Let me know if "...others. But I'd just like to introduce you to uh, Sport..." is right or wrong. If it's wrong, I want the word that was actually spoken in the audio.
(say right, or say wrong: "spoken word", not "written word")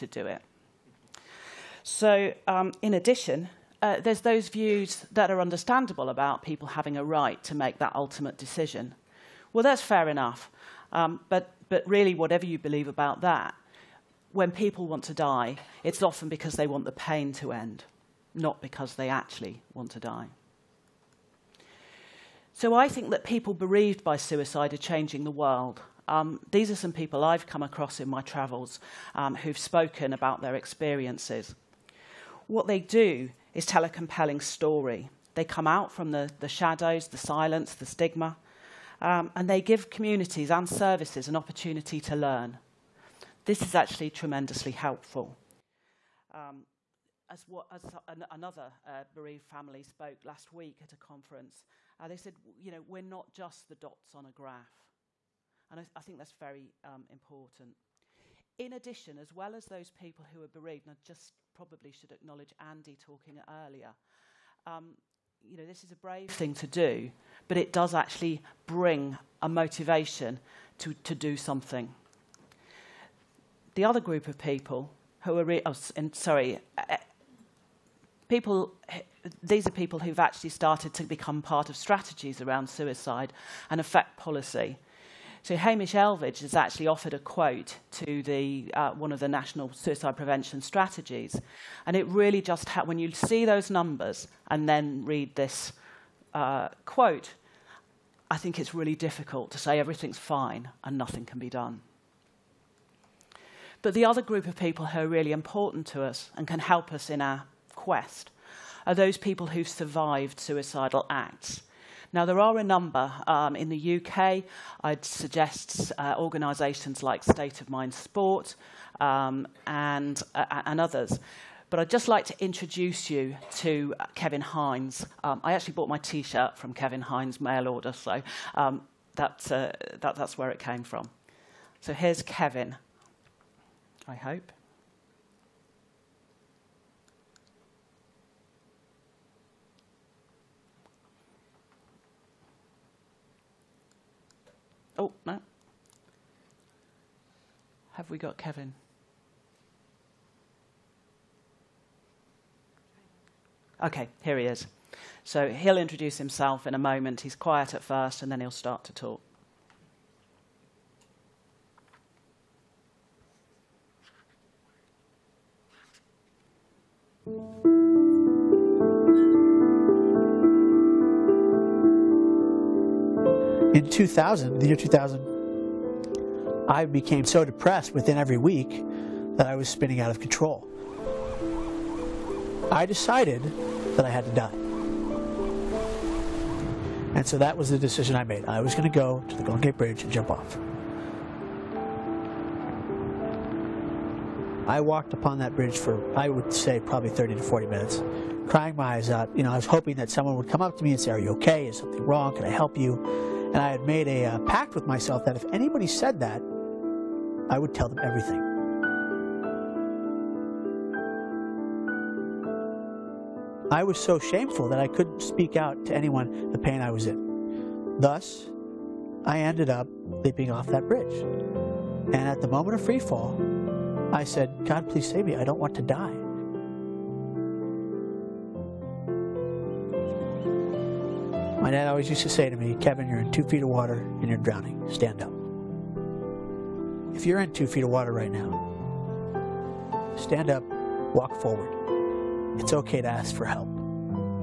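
wrong: "Kevin", not "Sport".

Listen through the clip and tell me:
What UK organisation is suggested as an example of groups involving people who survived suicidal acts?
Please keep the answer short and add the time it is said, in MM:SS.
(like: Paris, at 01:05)
State of Mind Sport, at 01:57.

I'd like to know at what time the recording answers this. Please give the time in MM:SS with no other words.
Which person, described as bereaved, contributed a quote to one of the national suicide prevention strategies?
01:25.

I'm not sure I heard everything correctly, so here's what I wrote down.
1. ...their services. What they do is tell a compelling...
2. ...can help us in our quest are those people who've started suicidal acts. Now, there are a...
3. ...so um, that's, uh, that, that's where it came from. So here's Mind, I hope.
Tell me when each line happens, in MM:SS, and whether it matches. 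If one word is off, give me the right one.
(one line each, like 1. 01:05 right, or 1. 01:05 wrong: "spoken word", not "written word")
1. 00:30 wrong: "experiences", not "services"
2. 01:46 wrong: "survived", not "started"
3. 02:07 wrong: "Kevin", not "Mind".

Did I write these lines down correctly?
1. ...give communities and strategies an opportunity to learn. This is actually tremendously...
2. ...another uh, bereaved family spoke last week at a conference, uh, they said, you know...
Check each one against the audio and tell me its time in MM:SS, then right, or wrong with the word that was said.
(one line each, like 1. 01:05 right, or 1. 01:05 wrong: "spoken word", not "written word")
1. 00:39 wrong: "services", not "strategies"
2. 00:48 right.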